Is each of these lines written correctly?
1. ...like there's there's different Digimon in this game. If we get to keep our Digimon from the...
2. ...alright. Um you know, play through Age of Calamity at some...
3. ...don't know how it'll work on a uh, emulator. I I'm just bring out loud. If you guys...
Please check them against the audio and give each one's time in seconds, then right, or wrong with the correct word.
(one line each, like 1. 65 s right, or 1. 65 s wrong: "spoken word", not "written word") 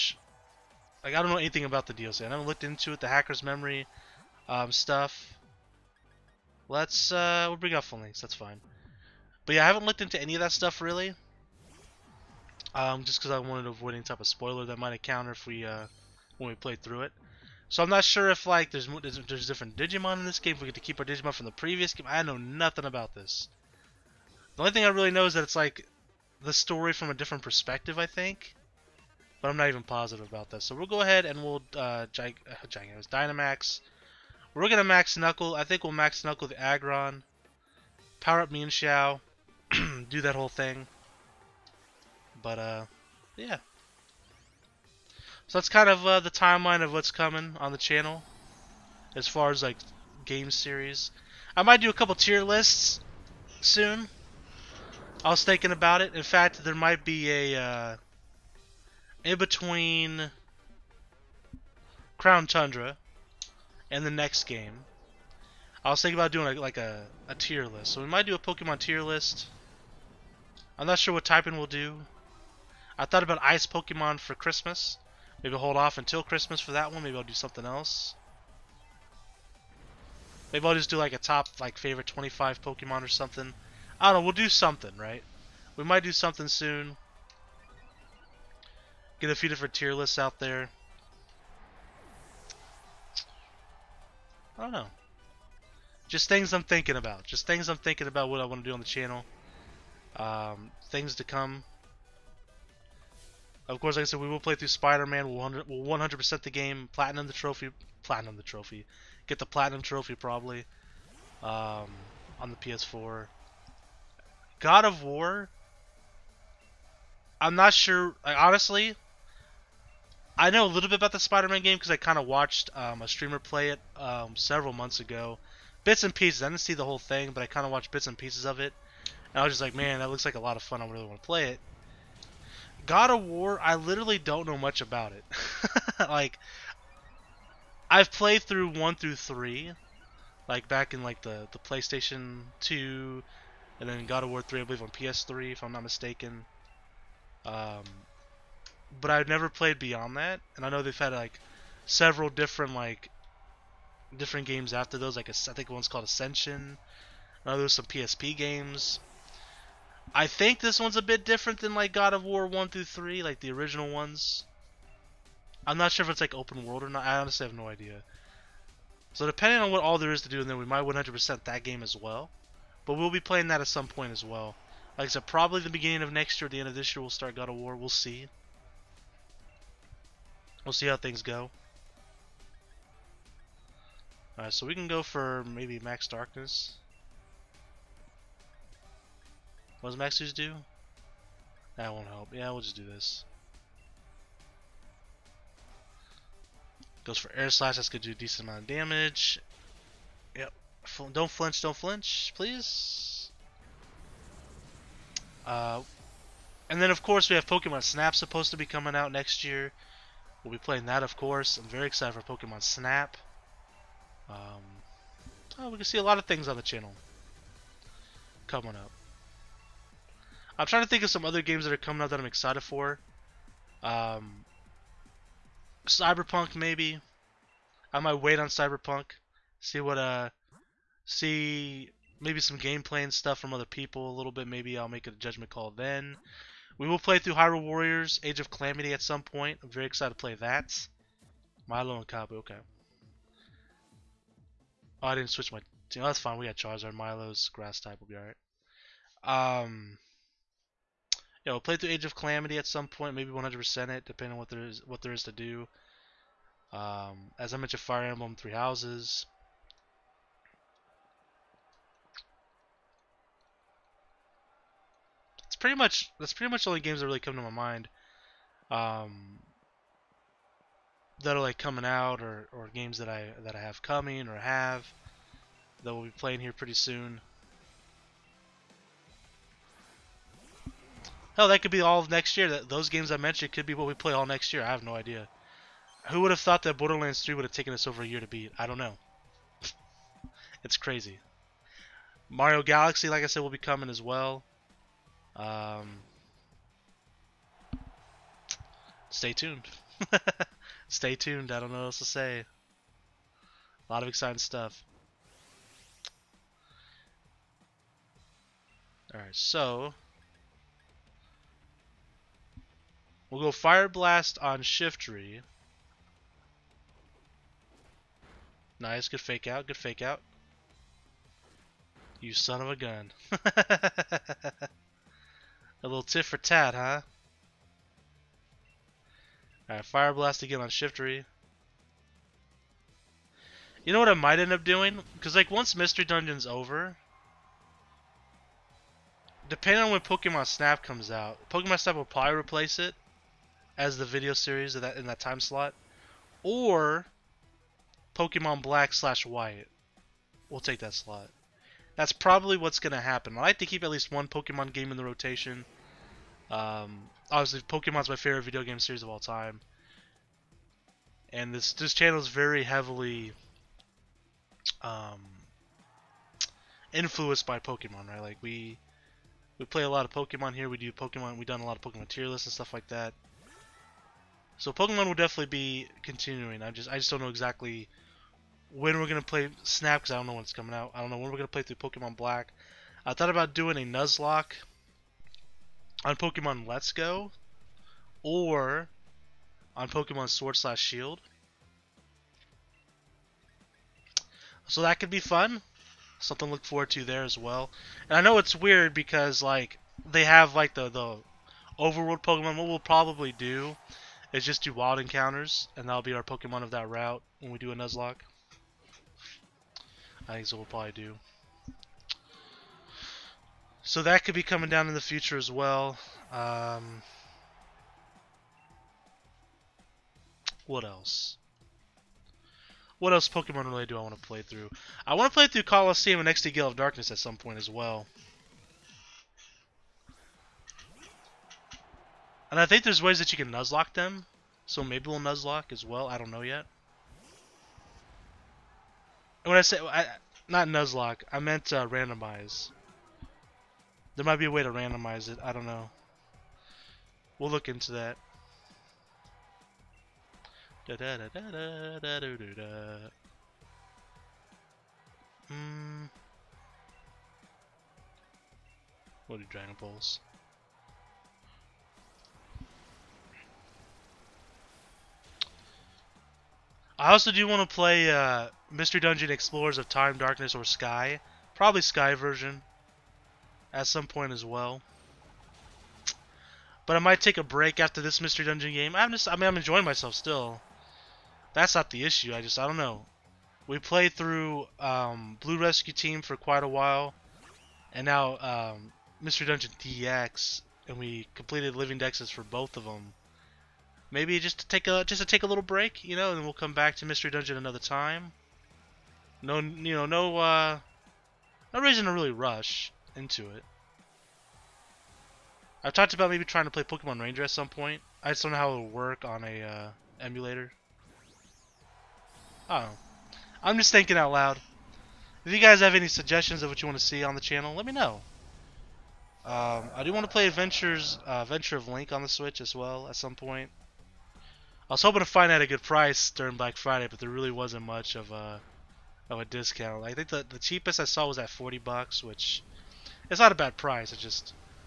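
1. 18 s right
2. 248 s right
3. 508 s wrong: "thinking", not "bring".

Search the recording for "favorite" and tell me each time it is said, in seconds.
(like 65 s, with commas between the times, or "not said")
81 s, 358 s.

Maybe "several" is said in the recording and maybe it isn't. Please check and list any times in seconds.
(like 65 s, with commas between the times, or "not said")
124 s, 151 s.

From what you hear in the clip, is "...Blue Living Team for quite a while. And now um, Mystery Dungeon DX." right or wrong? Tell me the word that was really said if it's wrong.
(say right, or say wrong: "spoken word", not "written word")
wrong: "Rescue", not "Living".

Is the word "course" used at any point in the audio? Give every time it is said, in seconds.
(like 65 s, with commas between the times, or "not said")
103 s, 207 s, 211 s.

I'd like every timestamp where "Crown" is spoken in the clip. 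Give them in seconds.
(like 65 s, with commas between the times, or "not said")
62 s.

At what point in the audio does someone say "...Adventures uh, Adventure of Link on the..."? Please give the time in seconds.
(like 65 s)
520 s.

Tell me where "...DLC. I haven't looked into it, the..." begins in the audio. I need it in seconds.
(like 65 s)
1 s.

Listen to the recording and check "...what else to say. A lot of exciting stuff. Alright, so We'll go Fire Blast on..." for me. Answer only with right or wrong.
right.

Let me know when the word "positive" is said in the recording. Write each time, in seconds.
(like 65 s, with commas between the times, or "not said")
29 s.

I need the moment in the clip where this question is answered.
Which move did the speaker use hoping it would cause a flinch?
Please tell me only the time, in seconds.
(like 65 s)
197 s.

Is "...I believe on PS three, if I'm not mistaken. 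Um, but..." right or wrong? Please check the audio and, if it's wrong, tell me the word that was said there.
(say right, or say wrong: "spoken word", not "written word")
right.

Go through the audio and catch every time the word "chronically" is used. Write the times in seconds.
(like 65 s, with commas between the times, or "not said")
not said.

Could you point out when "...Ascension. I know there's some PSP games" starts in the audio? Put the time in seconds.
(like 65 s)
156 s.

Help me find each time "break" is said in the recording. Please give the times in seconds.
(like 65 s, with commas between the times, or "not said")
477 s, 495 s.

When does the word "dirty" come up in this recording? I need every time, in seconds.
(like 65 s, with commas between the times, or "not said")
not said.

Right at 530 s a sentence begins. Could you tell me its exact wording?
I think the the cheapest I saw was at 40 bucks, which it's not a bad price.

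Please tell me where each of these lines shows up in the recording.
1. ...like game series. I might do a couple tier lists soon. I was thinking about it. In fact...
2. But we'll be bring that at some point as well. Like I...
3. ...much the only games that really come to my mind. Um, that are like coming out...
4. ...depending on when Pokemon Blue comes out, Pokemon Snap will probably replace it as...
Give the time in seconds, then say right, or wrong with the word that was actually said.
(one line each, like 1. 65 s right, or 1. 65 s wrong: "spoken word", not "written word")
1. 49 s right
2. 172 s wrong: "playing", not "bring"
3. 266 s right
4. 339 s wrong: "Snap", not "Blue".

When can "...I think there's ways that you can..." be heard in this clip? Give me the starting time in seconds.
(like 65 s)
432 s.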